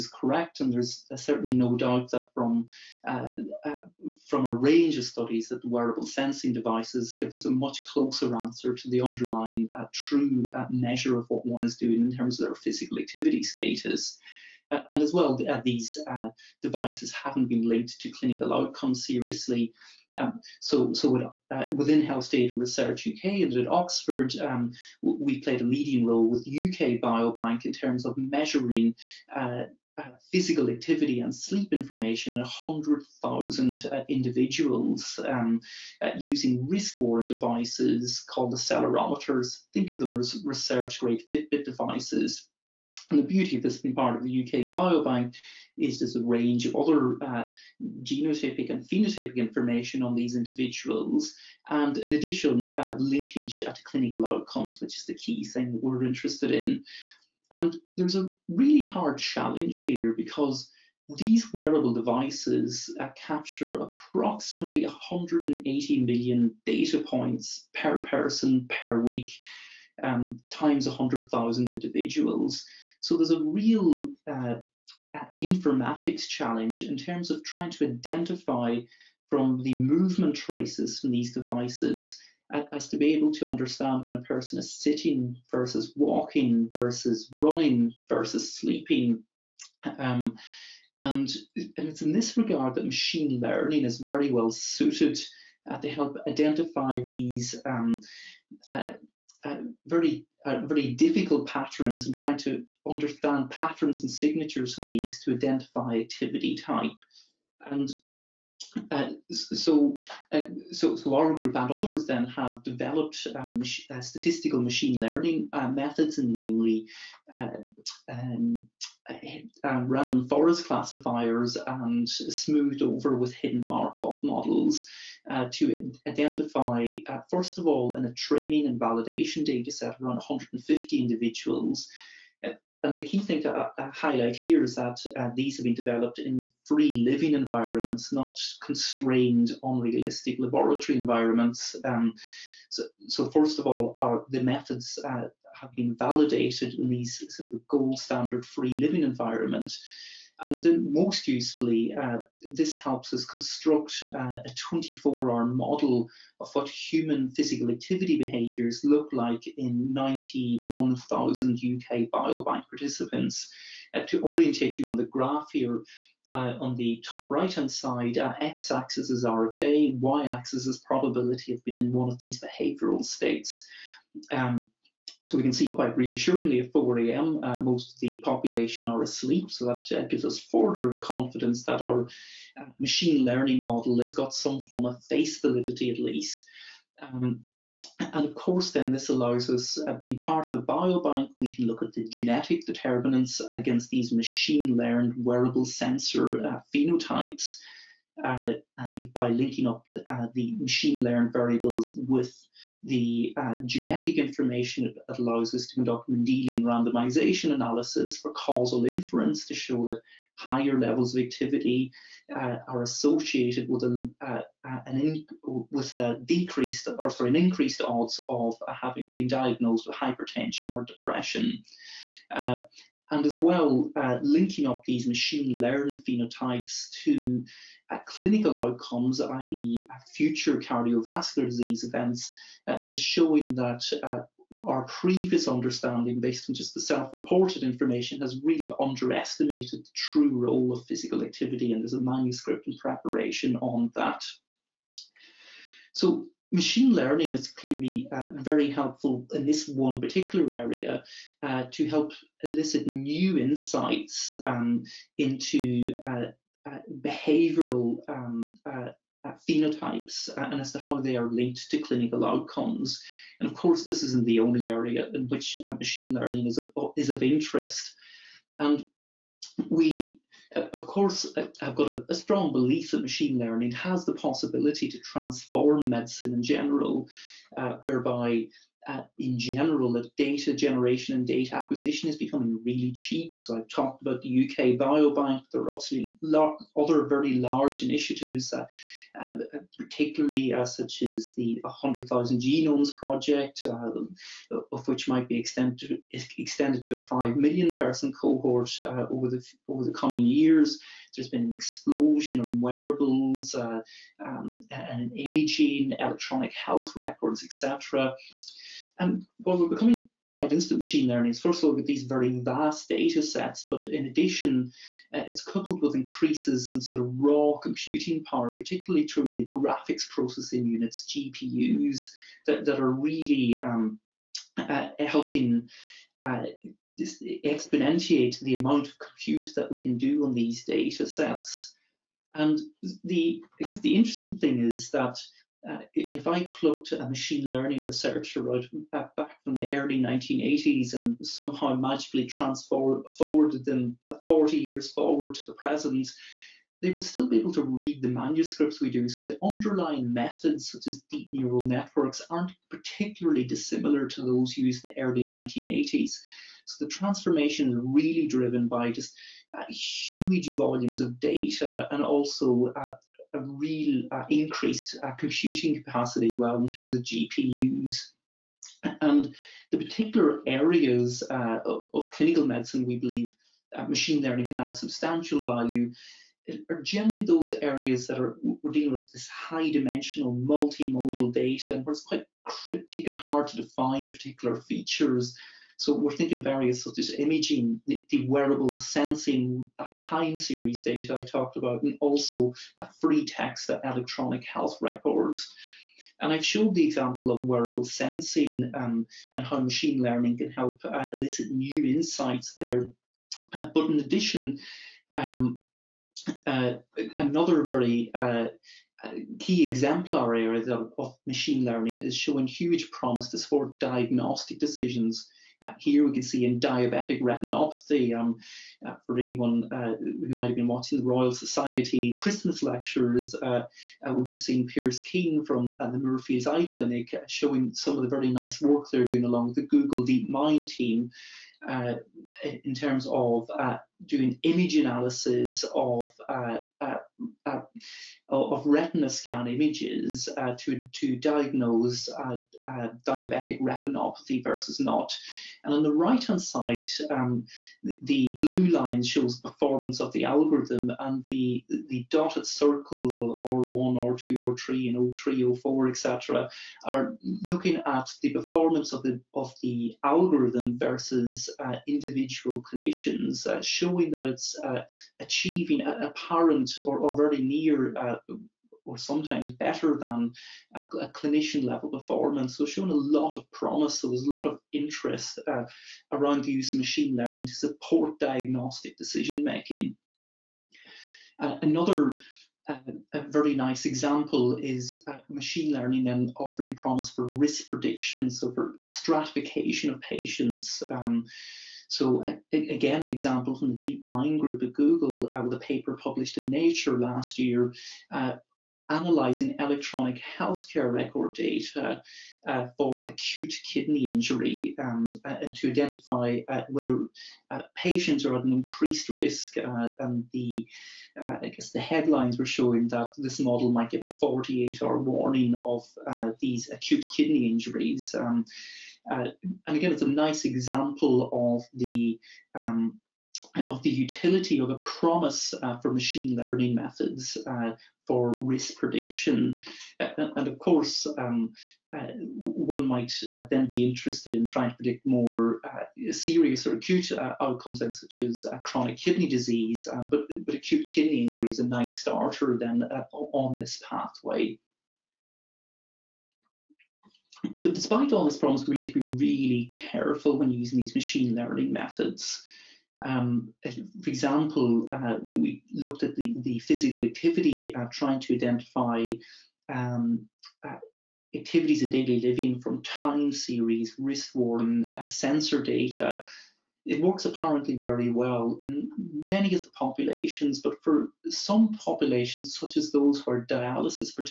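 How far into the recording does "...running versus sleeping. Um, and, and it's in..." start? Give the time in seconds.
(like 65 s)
87 s.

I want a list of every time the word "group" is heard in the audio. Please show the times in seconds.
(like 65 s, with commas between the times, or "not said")
111 s, 494 s.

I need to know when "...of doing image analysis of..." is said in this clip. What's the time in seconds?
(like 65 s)
433 s.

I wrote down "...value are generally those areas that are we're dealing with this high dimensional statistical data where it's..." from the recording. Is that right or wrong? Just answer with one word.
wrong.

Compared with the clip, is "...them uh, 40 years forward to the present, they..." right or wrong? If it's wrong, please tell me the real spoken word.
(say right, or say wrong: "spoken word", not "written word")
right.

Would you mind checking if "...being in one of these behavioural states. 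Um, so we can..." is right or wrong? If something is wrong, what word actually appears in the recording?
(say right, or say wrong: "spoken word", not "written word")
right.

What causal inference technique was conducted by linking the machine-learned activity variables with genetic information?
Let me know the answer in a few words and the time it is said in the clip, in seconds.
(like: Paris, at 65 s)
Mendelian randomization, at 206 s.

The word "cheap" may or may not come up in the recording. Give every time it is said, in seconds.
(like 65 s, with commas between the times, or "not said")
282 s.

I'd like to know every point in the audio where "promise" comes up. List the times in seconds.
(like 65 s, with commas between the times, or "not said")
412 s, 473 s, 486 s, 524 s.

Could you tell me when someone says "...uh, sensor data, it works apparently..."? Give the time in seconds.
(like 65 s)
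564 s.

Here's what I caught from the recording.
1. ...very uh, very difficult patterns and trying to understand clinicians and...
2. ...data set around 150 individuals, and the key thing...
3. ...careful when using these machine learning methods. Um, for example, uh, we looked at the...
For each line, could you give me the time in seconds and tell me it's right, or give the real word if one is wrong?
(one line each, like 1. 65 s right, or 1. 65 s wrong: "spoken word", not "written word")
1. 99 s wrong: "patterns", not "clinicians"
2. 129 s right
3. 549 s right.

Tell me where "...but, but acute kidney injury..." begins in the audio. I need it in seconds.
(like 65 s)
540 s.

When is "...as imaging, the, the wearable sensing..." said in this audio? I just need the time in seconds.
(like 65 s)
386 s.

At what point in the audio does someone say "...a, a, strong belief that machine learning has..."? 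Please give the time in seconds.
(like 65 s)
271 s.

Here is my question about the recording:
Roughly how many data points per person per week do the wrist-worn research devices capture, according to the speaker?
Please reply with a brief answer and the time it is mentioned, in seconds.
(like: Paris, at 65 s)
180 million, at 64 s.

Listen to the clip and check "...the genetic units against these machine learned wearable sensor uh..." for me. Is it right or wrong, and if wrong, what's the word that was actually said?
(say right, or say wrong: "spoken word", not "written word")
wrong: "determinants", not "units".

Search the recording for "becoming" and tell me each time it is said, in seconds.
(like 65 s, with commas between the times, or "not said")
282 s, 309 s.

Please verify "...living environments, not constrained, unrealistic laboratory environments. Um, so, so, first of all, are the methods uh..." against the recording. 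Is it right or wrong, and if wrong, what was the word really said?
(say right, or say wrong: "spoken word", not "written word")
right.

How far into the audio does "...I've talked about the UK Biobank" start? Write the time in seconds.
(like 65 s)
283 s.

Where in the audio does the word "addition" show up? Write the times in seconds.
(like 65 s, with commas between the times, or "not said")
52 s, 314 s, 403 s.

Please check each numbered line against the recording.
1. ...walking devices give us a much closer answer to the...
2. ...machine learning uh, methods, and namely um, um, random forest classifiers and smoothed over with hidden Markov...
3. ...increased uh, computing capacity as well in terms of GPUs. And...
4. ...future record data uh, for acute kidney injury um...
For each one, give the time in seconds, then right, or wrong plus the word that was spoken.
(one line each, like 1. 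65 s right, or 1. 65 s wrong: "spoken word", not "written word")
1. 6 s wrong: "sensing", not "walking"
2. 114 s right
3. 364 s right
4. 500 s wrong: "healthcare", not "future".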